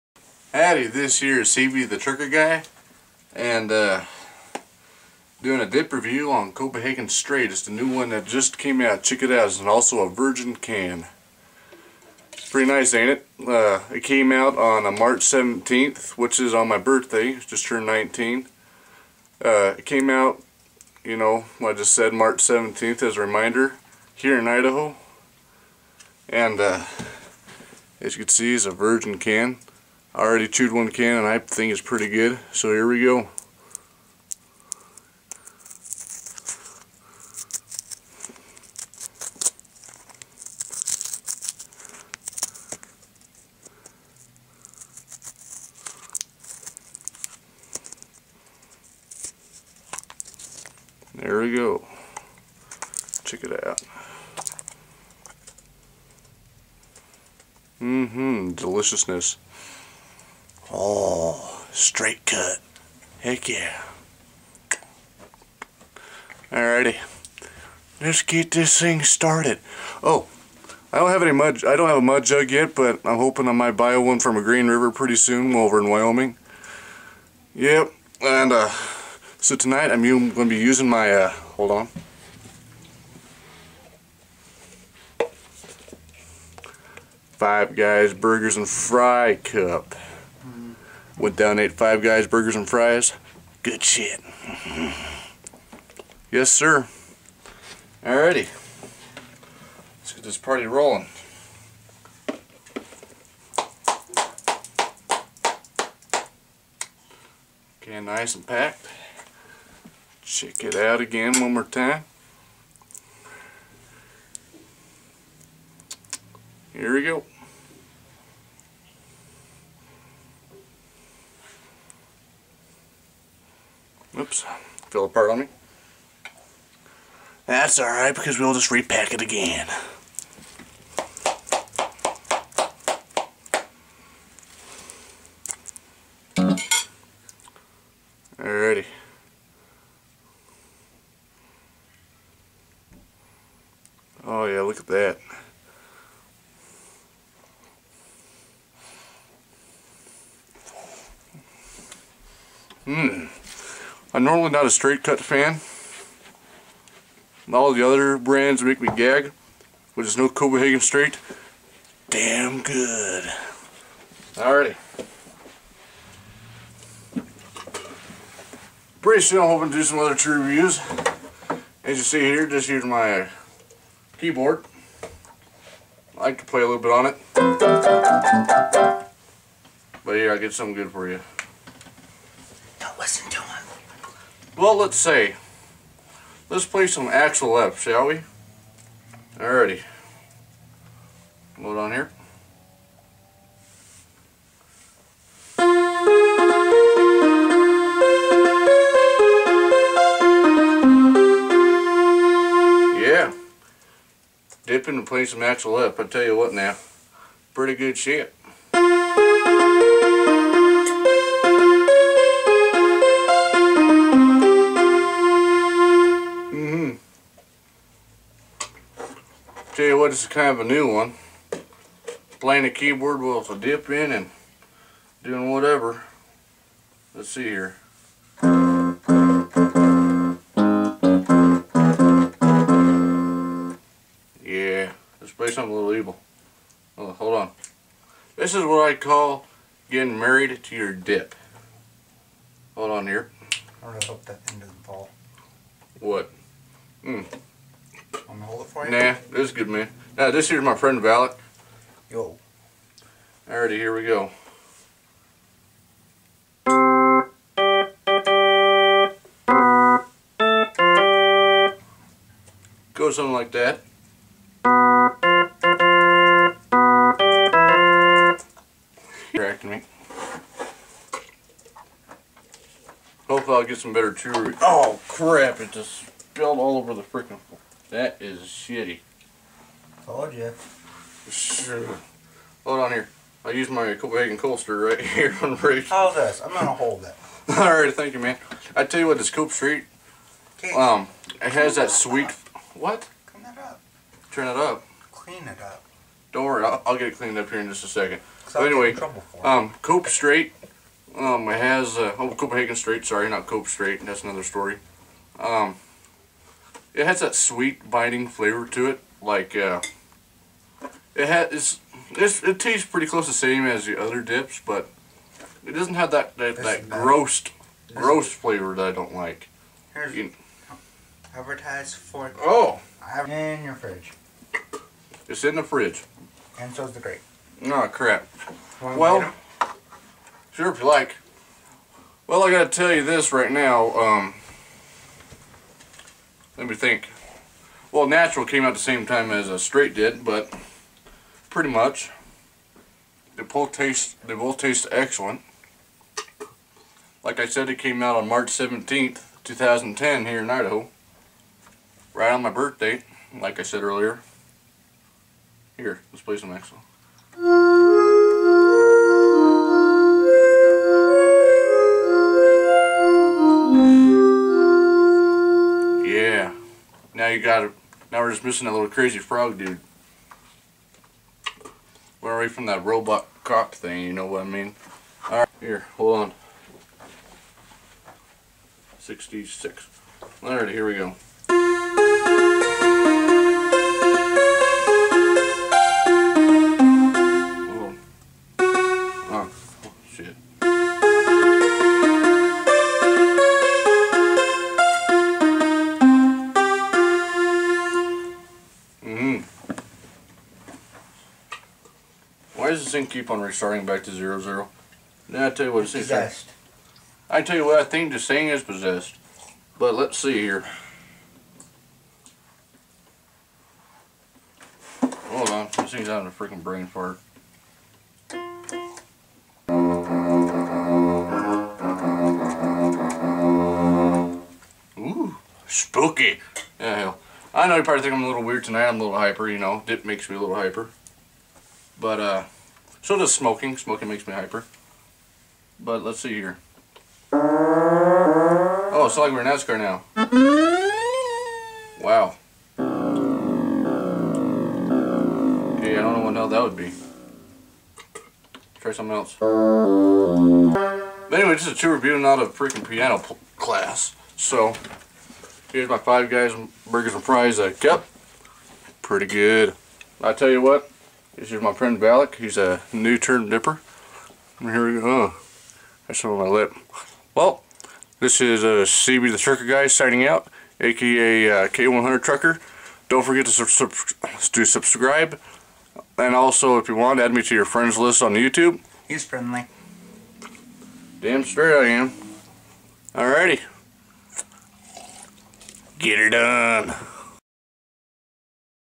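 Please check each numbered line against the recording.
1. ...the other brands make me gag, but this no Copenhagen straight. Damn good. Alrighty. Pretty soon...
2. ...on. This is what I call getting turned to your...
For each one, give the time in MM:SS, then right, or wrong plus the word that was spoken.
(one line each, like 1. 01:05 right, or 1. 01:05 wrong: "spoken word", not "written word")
1. 02:37 right
2. 03:57 wrong: "married", not "turned".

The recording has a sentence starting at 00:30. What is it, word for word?
I already chewed one can and I think it's pretty good.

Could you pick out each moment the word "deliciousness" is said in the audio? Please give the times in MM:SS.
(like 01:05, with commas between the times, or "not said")
00:58.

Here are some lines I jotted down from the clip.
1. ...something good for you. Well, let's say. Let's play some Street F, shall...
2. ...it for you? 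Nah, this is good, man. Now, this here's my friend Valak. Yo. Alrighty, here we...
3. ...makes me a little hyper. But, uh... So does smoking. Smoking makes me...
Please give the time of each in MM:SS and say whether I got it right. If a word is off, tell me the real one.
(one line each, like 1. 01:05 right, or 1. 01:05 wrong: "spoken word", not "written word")
1. 03:00 wrong: "Axel", not "Street"
2. 04:08 right
3. 07:10 right.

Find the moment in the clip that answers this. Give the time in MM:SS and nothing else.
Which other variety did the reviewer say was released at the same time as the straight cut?
05:38.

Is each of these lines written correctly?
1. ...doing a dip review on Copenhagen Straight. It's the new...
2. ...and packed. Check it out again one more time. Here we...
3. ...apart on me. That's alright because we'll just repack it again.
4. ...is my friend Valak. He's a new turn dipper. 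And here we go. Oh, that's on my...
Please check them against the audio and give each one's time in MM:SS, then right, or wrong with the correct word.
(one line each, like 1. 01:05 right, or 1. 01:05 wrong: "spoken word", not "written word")
1. 00:05 right
2. 01:48 right
3. 02:05 right
4. 07:41 right.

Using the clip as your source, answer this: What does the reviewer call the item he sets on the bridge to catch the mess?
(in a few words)
Copenhagen Coaster.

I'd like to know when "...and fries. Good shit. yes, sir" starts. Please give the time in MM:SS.
01:32.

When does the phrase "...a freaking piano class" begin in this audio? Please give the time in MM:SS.
07:32.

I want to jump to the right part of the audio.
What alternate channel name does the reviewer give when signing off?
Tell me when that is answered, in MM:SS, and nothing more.
07:51.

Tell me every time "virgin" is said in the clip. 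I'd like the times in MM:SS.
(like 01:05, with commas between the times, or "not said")
00:10, 00:28.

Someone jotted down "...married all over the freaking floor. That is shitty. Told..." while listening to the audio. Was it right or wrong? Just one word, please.
wrong.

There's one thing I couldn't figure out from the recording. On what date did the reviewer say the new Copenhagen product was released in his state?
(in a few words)
March 17th.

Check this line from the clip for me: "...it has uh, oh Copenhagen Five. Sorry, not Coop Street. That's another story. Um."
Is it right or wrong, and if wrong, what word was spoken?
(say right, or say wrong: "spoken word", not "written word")
wrong: "Straight", not "Five".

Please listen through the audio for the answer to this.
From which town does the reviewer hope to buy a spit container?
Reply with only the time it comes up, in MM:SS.
01:14.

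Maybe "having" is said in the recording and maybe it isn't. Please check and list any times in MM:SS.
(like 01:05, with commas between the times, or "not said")
06:56.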